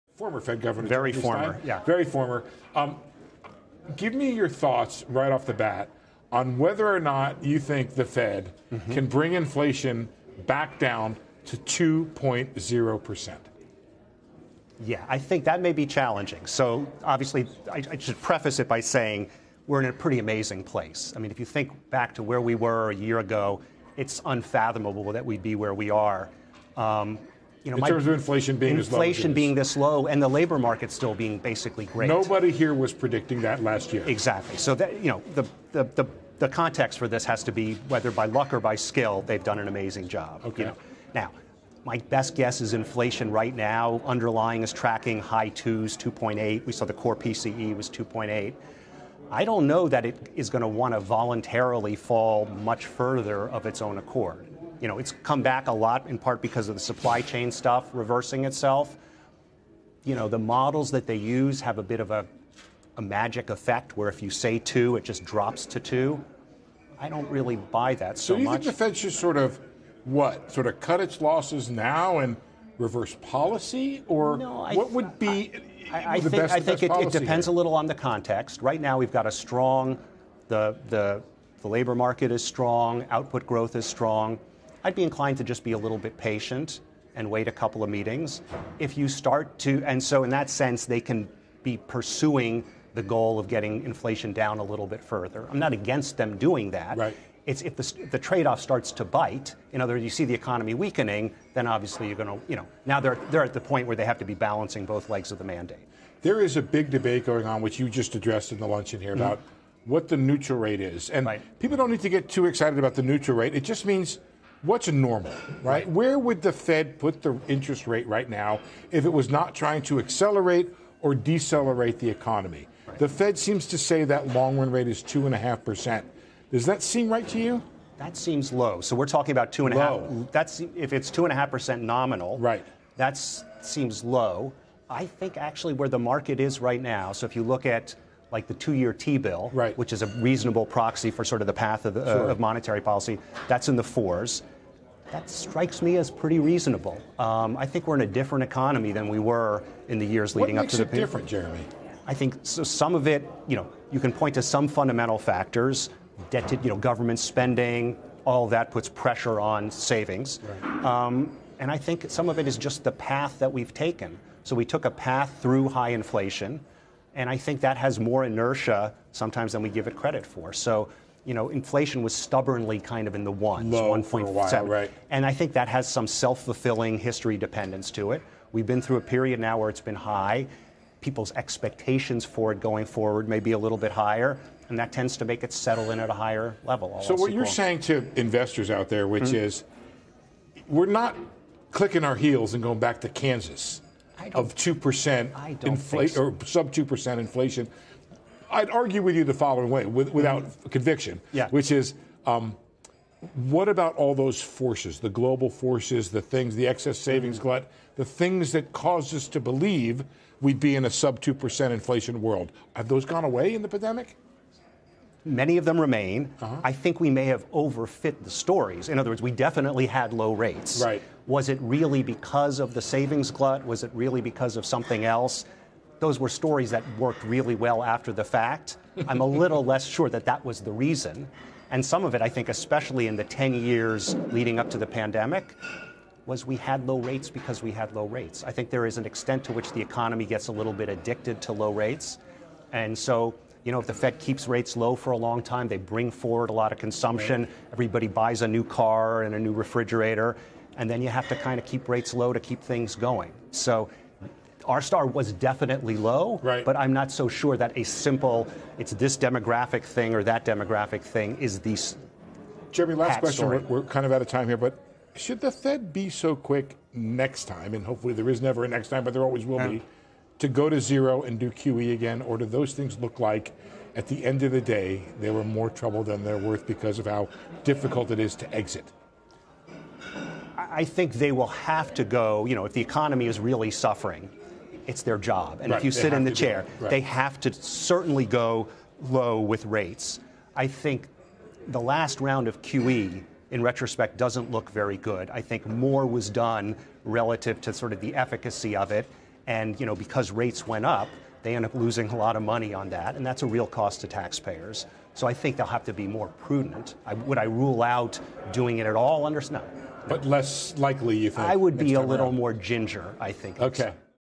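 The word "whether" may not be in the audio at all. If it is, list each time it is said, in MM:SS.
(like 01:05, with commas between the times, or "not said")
00:06, 00:37.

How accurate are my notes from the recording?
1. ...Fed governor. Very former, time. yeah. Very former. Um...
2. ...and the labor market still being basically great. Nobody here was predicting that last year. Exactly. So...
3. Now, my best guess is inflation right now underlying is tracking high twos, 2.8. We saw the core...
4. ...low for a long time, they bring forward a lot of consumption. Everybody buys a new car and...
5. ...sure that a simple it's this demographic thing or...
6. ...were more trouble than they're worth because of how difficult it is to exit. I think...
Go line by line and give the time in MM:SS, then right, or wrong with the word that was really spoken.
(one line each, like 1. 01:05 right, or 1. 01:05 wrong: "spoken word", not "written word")
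1. 00:00 right
2. 00:30 right
3. 00:41 right
4. 04:04 right
5. 04:17 right
6. 04:35 right.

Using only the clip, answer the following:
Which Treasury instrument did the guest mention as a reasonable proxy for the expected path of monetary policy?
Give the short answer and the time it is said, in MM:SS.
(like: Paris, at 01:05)
two-year T-bill, at 02:18.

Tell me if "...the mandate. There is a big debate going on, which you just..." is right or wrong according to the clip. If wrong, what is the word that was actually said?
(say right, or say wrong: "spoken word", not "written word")
right.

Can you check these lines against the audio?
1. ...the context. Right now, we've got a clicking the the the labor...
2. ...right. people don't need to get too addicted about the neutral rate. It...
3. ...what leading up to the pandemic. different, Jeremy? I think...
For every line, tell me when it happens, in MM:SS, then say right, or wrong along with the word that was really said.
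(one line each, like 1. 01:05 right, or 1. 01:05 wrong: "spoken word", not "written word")
1. 01:17 wrong: "strong", not "clicking"
2. 01:51 wrong: "excited", not "addicted"
3. 02:30 right.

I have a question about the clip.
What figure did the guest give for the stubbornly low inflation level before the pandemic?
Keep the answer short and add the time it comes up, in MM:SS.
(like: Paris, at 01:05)
1.7, at 02:53.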